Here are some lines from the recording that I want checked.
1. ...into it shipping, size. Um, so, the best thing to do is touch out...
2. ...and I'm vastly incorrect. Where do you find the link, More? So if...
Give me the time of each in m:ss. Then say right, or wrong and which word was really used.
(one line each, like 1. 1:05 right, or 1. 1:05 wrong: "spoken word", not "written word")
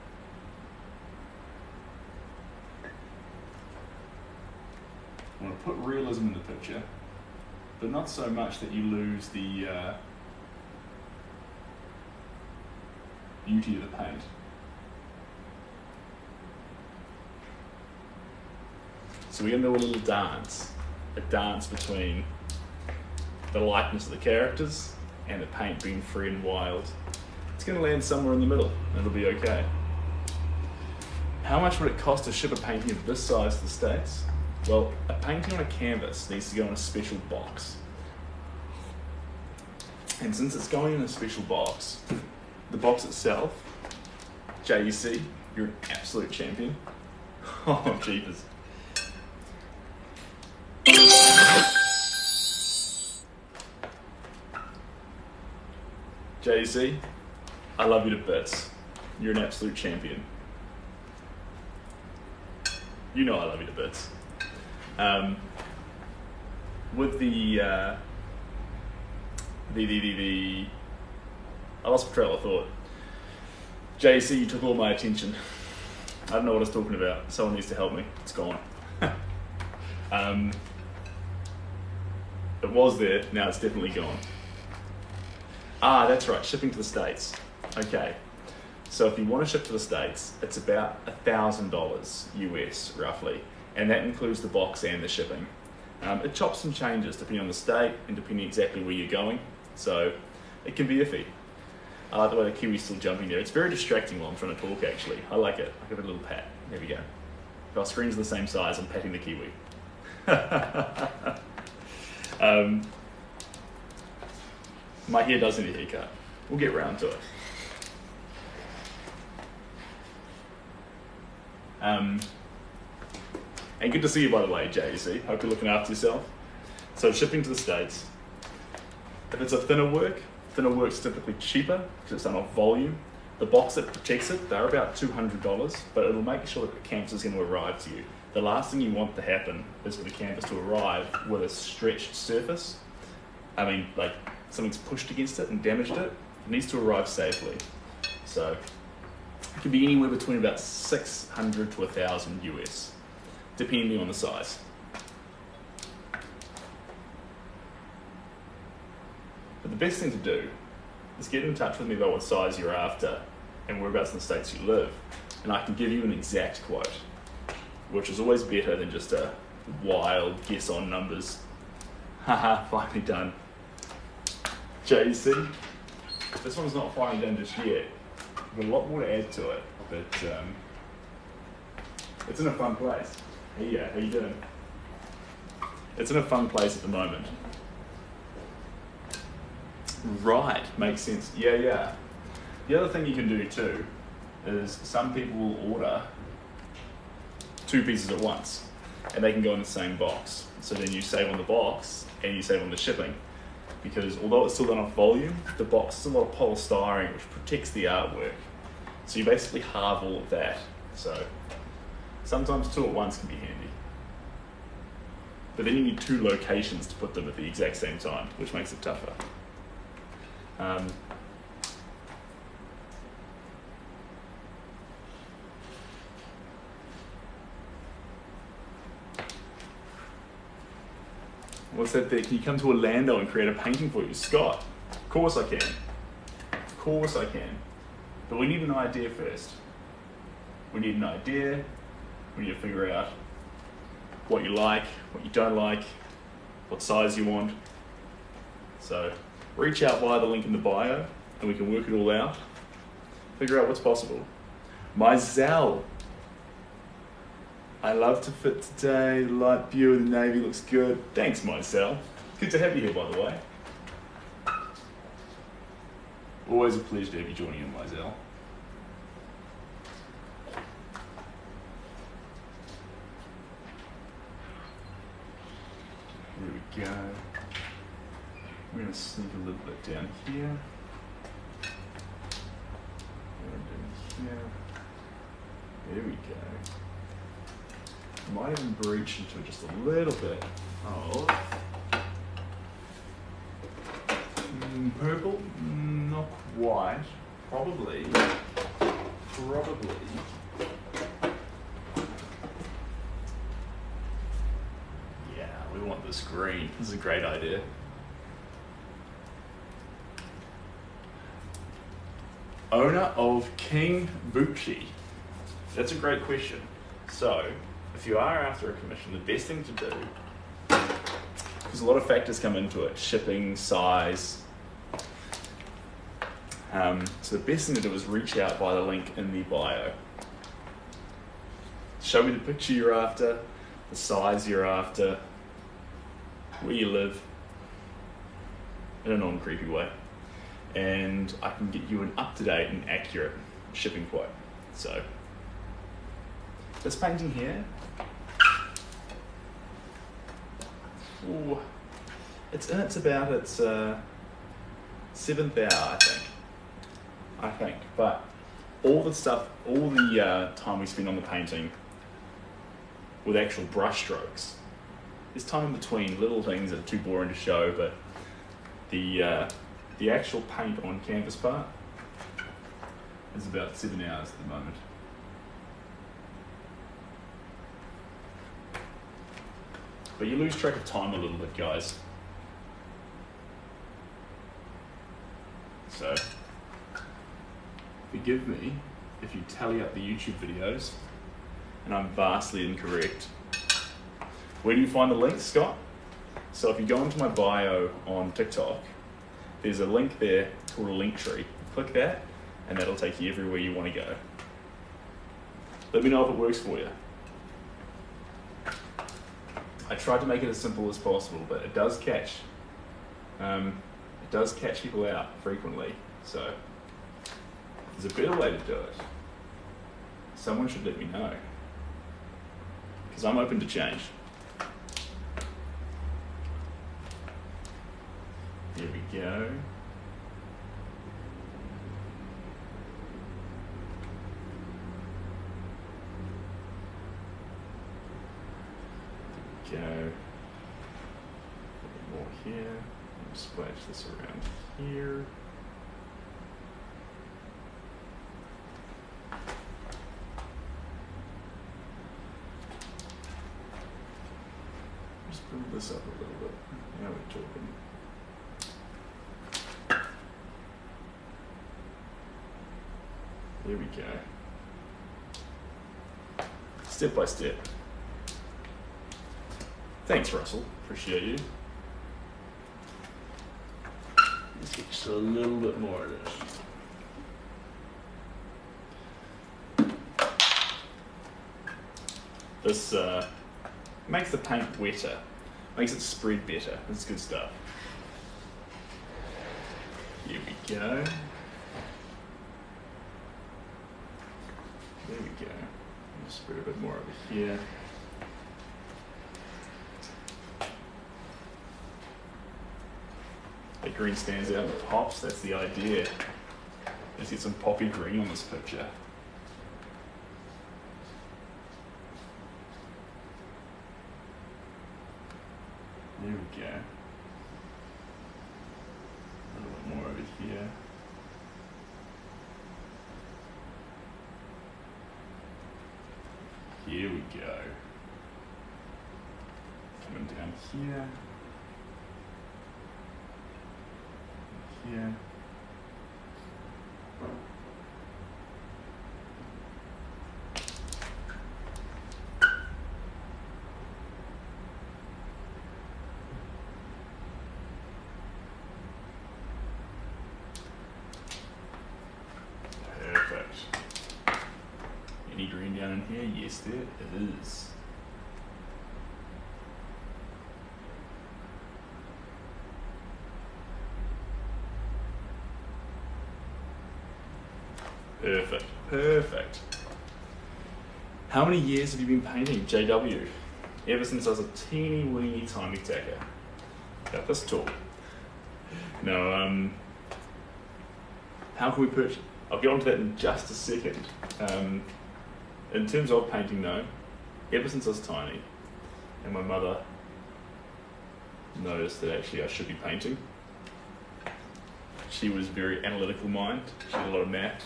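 1. 5:22 wrong: "reach", not "touch"
2. 6:31 wrong: "Scott", not "More".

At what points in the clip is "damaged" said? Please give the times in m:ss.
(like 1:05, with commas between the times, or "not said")
2:25.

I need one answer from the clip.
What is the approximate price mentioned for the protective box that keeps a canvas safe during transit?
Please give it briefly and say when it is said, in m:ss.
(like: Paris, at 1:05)
$200, at 2:14.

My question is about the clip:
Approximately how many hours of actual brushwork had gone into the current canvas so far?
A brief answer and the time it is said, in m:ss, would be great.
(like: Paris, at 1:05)
Seven, at 6:13.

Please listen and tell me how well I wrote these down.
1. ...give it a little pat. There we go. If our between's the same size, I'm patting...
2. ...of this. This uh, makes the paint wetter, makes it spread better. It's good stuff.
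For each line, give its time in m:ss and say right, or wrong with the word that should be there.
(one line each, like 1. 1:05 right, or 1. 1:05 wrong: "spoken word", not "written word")
1. 1:45 wrong: "screen", not "between"
2. 7:56 right.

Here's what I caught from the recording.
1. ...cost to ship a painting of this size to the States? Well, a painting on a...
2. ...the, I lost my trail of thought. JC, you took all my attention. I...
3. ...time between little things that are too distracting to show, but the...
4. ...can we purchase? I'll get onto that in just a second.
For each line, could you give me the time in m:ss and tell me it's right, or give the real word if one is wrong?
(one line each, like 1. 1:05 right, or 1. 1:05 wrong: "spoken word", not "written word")
1. 0:31 right
2. 1:10 right
3. 6:05 wrong: "boring", not "distracting"
4. 9:41 right.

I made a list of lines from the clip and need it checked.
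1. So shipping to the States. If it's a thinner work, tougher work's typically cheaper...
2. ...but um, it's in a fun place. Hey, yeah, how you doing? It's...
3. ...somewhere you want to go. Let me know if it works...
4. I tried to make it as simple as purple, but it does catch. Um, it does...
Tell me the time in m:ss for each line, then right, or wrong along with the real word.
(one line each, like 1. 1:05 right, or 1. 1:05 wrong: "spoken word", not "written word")
1. 2:06 wrong: "thinner", not "tougher"
2. 2:59 right
3. 6:43 wrong: "everywhere", not "somewhere"
4. 6:49 wrong: "possible", not "purple".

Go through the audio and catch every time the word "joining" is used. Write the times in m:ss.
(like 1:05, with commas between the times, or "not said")
4:27.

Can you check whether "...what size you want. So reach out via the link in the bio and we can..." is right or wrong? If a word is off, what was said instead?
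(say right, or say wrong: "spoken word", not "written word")
right.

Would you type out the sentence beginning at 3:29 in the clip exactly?
So you basically halve all of that.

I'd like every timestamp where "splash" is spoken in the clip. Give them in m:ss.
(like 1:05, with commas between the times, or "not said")
7:23.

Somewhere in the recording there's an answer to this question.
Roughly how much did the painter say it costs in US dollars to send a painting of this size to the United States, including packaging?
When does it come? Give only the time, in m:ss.
1:31.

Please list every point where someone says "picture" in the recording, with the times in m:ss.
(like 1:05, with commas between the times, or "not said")
0:06, 5:32, 8:28.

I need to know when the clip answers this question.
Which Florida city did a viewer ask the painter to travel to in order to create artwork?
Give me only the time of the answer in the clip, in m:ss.
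3:52.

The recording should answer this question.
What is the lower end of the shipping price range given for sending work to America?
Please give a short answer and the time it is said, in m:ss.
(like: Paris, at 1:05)
600, at 2:30.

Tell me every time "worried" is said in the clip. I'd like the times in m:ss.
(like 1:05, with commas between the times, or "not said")
not said.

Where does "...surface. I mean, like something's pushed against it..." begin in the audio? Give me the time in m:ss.
2:22.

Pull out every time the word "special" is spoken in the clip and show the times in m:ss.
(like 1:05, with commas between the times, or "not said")
0:36, 0:41.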